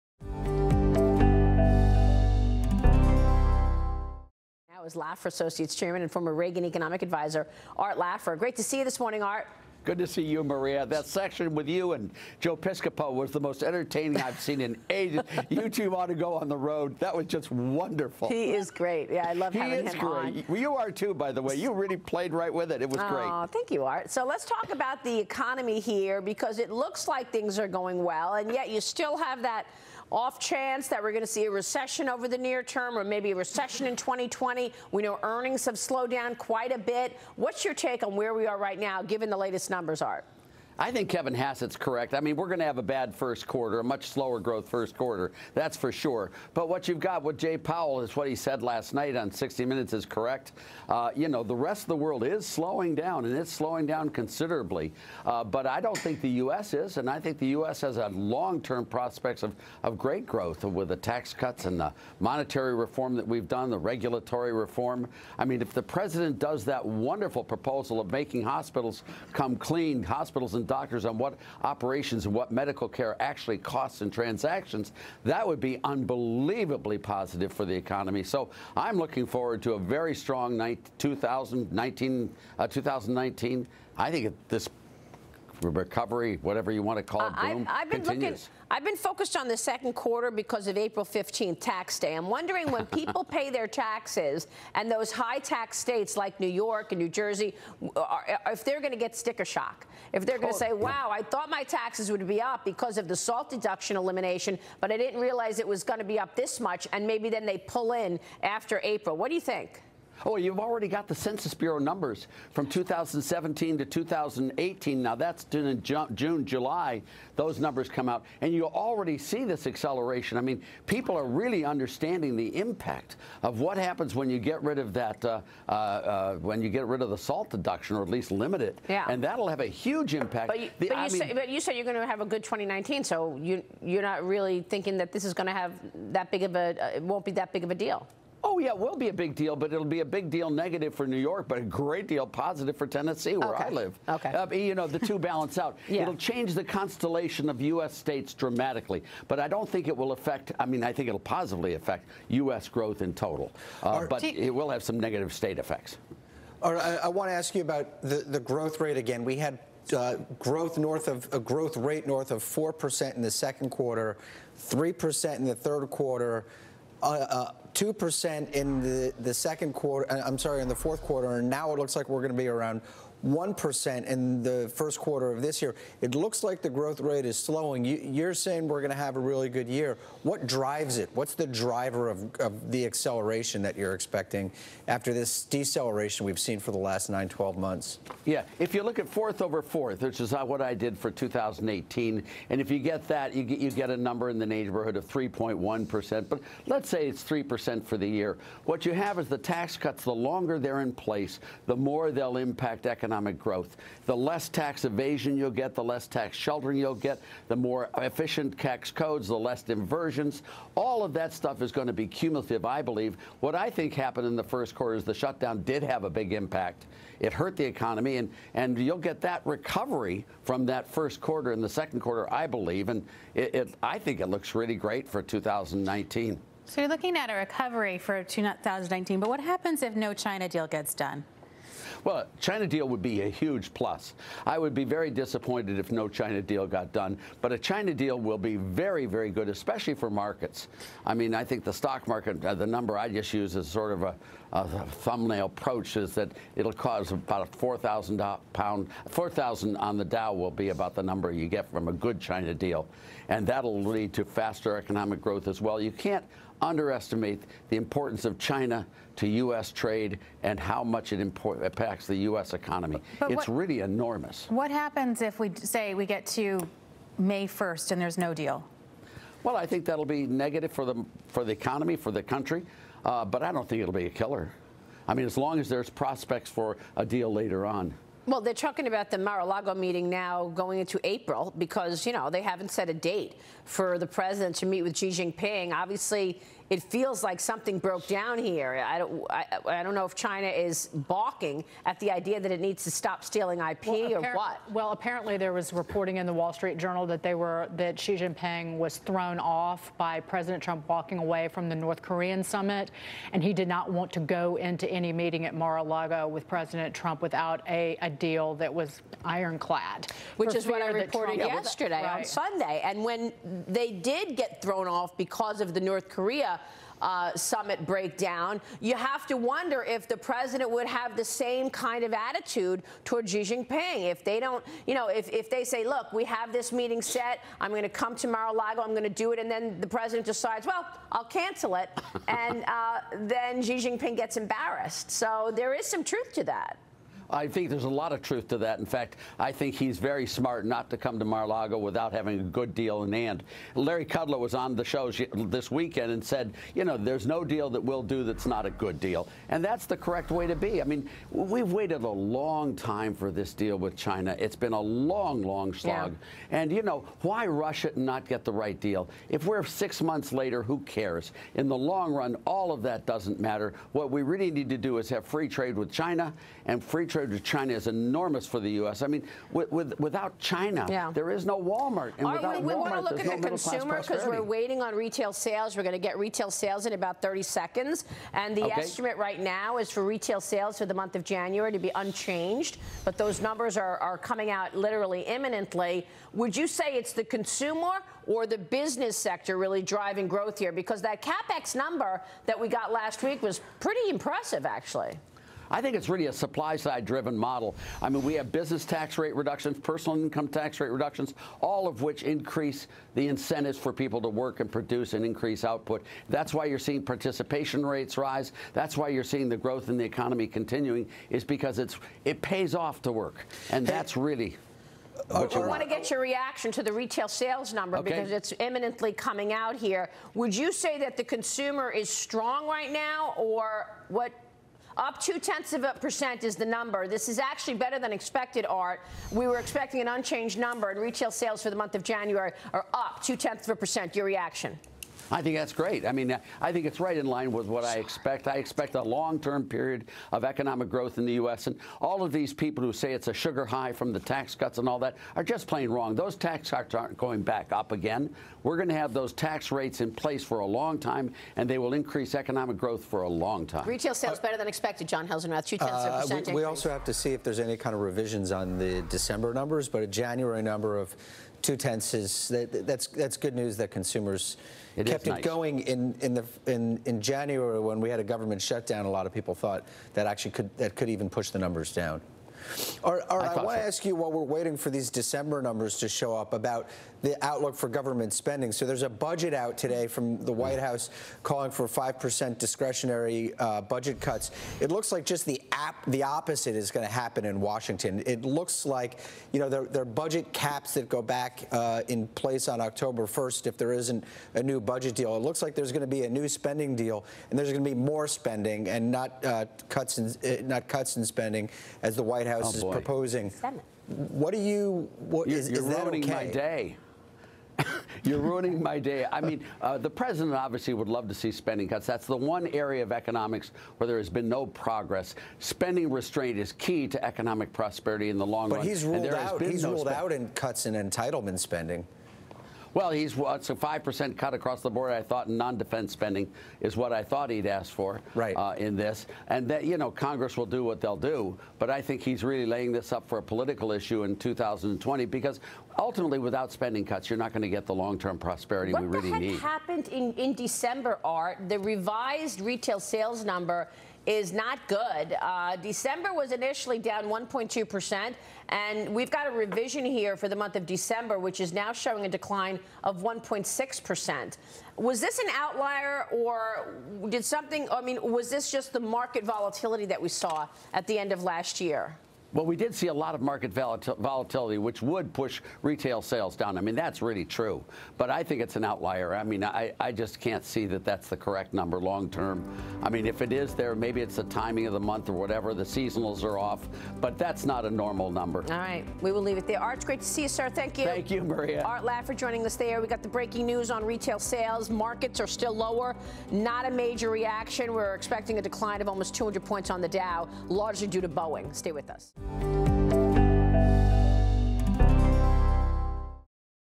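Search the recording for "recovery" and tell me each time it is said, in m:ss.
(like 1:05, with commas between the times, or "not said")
1:25, 3:39, 3:47.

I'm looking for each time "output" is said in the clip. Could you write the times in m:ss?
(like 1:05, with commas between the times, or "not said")
6:45.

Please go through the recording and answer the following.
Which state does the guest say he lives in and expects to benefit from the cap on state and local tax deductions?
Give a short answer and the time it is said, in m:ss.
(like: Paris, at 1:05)
Tennessee, at 2:22.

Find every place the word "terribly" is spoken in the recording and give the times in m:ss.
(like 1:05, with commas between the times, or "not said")
not said.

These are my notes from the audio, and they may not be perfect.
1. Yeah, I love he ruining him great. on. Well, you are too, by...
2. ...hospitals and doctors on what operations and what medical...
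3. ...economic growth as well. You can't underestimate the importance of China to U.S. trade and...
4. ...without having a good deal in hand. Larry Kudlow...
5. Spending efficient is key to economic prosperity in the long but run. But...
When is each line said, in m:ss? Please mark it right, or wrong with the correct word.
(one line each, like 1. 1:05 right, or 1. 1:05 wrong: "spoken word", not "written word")
1. 0:19 wrong: "having", not "ruining"
2. 1:10 right
3. 4:14 right
4. 5:41 right
5. 8:35 wrong: "restraint", not "efficient".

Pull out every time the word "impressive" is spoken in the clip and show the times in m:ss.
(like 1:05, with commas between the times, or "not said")
6:34.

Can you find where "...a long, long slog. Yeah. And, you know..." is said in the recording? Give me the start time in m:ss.
5:54.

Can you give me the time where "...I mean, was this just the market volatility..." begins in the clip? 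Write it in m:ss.
9:17.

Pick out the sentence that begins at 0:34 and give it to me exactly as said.
We know earnings have slowed down quite a bit.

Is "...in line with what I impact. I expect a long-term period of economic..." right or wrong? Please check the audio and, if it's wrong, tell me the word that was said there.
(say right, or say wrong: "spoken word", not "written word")
wrong: "expect", not "impact".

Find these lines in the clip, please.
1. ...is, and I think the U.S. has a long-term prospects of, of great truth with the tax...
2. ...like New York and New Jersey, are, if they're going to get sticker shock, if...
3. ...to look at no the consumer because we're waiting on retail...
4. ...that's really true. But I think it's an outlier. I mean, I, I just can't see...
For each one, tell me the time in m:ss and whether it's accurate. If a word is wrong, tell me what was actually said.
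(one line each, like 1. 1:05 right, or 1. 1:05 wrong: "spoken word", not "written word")
1. 0:56 wrong: "growth", not "truth"
2. 1:36 right
3. 6:12 right
4. 9:26 right.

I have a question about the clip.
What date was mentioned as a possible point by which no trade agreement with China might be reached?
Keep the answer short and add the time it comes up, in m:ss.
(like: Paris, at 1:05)
May 1st, at 4:27.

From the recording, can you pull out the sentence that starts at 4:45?
Obviously, it feels like something broke down here.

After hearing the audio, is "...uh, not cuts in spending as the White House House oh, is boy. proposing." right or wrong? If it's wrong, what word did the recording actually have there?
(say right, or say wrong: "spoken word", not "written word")
right.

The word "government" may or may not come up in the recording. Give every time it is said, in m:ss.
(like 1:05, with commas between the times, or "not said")
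7:48, 7:57.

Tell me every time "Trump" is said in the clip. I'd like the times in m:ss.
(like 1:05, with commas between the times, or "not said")
5:00, 5:06, 5:11.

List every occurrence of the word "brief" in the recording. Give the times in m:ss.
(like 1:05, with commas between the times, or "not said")
not said.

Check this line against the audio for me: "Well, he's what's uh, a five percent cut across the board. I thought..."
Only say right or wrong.
right.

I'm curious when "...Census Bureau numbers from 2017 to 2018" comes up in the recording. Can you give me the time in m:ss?
1:51.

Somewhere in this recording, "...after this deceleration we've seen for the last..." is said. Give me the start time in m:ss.
3:04.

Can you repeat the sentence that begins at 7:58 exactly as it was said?
So there's a budget out today from the White House calling for 5% discretionary uh, budget cuts.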